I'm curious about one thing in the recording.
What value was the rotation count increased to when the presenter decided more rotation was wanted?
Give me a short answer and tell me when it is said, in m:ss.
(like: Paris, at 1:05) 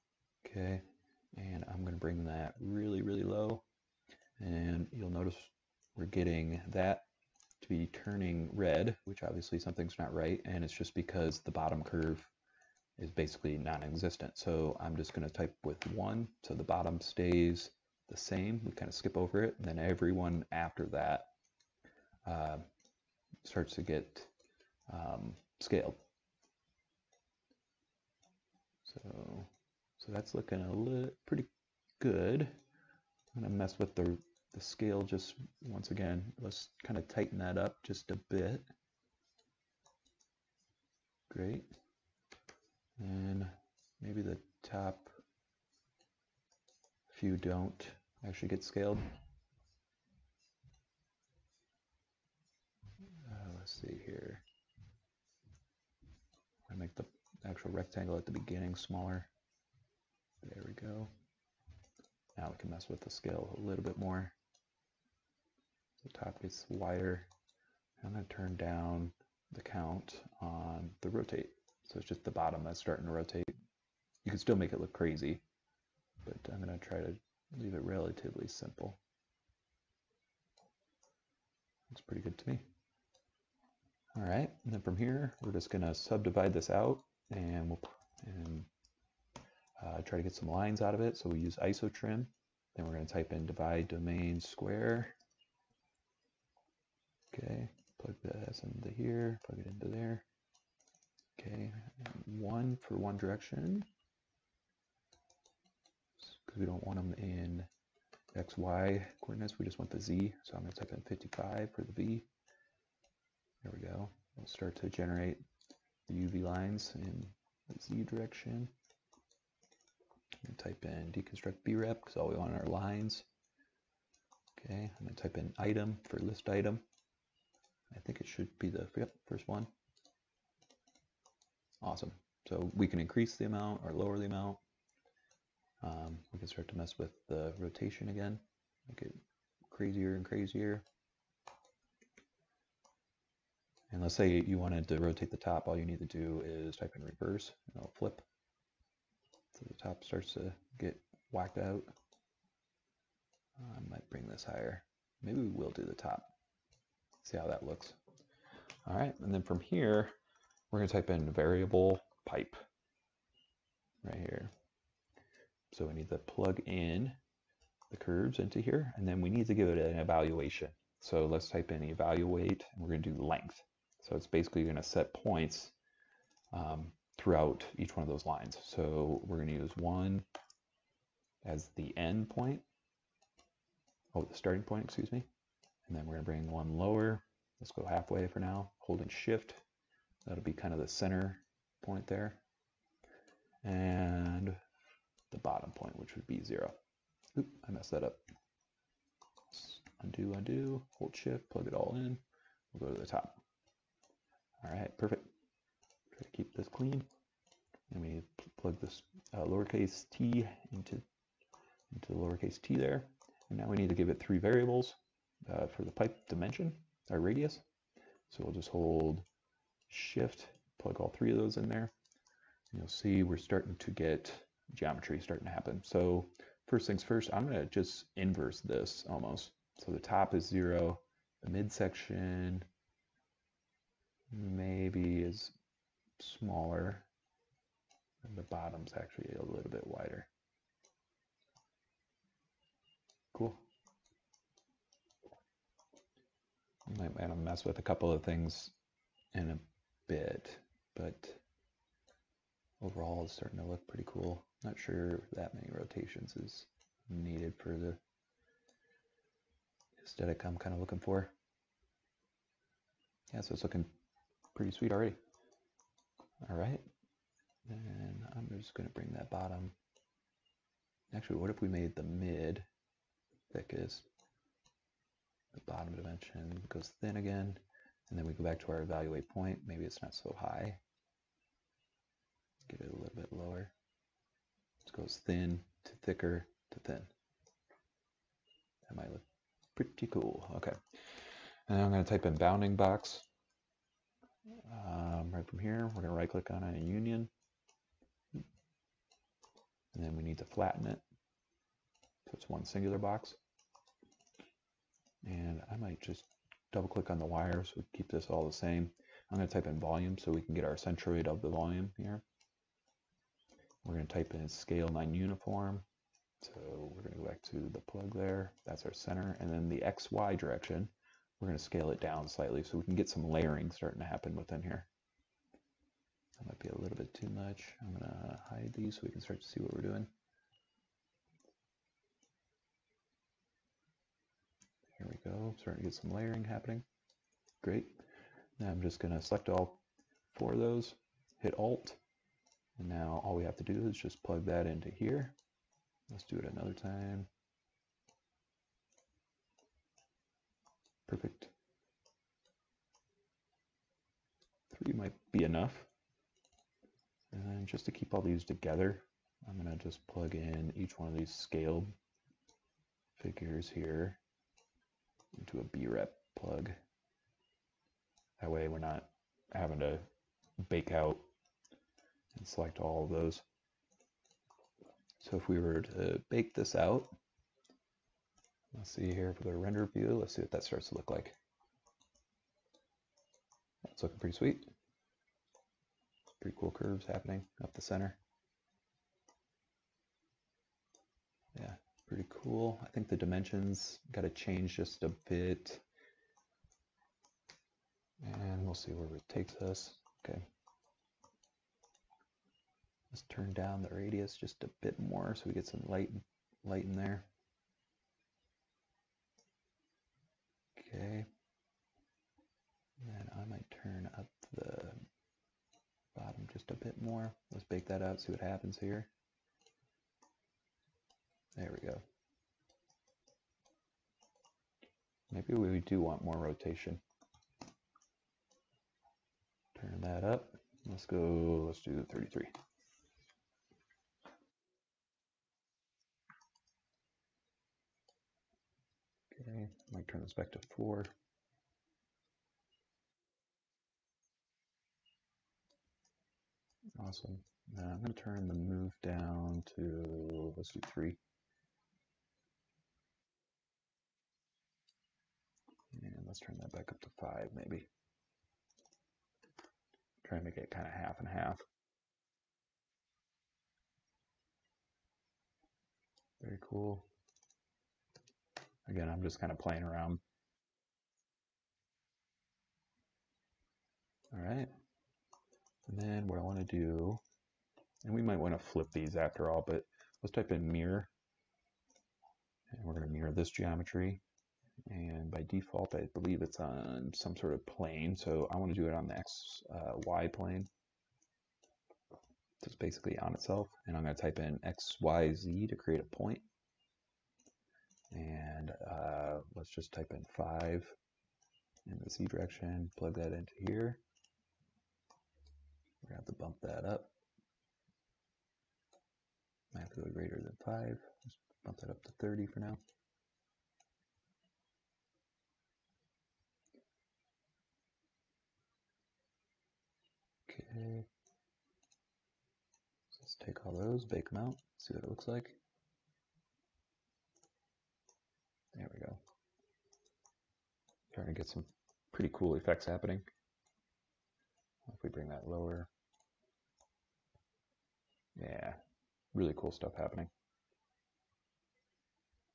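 33, at 7:12.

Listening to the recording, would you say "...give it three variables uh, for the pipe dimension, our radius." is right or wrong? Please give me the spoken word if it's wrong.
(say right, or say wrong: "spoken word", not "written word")
right.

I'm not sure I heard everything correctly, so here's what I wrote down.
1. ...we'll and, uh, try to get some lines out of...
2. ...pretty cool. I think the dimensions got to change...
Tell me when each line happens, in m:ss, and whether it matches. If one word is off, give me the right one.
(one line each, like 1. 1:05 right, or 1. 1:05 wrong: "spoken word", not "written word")
1. 1:27 right
2. 6:32 right.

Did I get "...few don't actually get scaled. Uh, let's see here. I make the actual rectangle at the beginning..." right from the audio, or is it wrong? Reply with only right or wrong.
right.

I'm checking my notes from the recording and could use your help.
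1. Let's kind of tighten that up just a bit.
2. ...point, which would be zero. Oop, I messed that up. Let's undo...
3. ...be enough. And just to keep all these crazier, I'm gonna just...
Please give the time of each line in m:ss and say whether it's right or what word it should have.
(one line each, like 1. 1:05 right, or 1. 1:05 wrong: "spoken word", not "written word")
1. 0:36 right
2. 3:15 right
3. 5:55 wrong: "together", not "crazier".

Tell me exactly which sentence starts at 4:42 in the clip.
Get it a little bit lower.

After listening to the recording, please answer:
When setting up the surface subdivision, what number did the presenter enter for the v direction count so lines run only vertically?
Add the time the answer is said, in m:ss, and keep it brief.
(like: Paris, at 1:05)
55, at 1:51.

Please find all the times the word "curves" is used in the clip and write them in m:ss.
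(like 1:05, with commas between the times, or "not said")
0:11, 2:47, 6:26.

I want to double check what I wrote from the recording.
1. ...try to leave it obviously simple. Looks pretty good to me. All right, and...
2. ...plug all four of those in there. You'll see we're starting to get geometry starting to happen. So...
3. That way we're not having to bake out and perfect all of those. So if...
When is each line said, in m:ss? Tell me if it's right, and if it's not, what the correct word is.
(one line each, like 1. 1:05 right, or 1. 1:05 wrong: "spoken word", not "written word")
1. 1:16 wrong: "relatively", not "obviously"
2. 3:40 wrong: "three", not "four"
3. 6:08 wrong: "select", not "perfect".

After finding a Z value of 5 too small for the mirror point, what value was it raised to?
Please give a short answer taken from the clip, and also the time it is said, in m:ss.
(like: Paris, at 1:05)
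30, at 8:32.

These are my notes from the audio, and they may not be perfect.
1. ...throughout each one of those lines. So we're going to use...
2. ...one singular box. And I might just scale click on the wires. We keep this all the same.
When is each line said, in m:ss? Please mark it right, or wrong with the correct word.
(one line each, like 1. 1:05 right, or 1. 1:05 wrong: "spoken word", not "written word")
1. 2:57 right
2. 5:02 wrong: "double", not "scale".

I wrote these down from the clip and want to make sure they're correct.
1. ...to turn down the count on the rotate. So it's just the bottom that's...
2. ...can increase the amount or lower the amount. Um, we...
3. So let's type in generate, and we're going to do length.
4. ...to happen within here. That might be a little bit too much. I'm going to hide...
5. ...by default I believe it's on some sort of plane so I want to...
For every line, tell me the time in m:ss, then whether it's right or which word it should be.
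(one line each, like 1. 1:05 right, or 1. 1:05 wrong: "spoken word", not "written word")
1. 1:08 right
2. 2:12 right
3. 2:51 wrong: "evaluate", not "generate"
4. 5:24 right
5. 8:05 right.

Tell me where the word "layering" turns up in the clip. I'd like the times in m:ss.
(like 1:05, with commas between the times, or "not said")
5:23, 5:36.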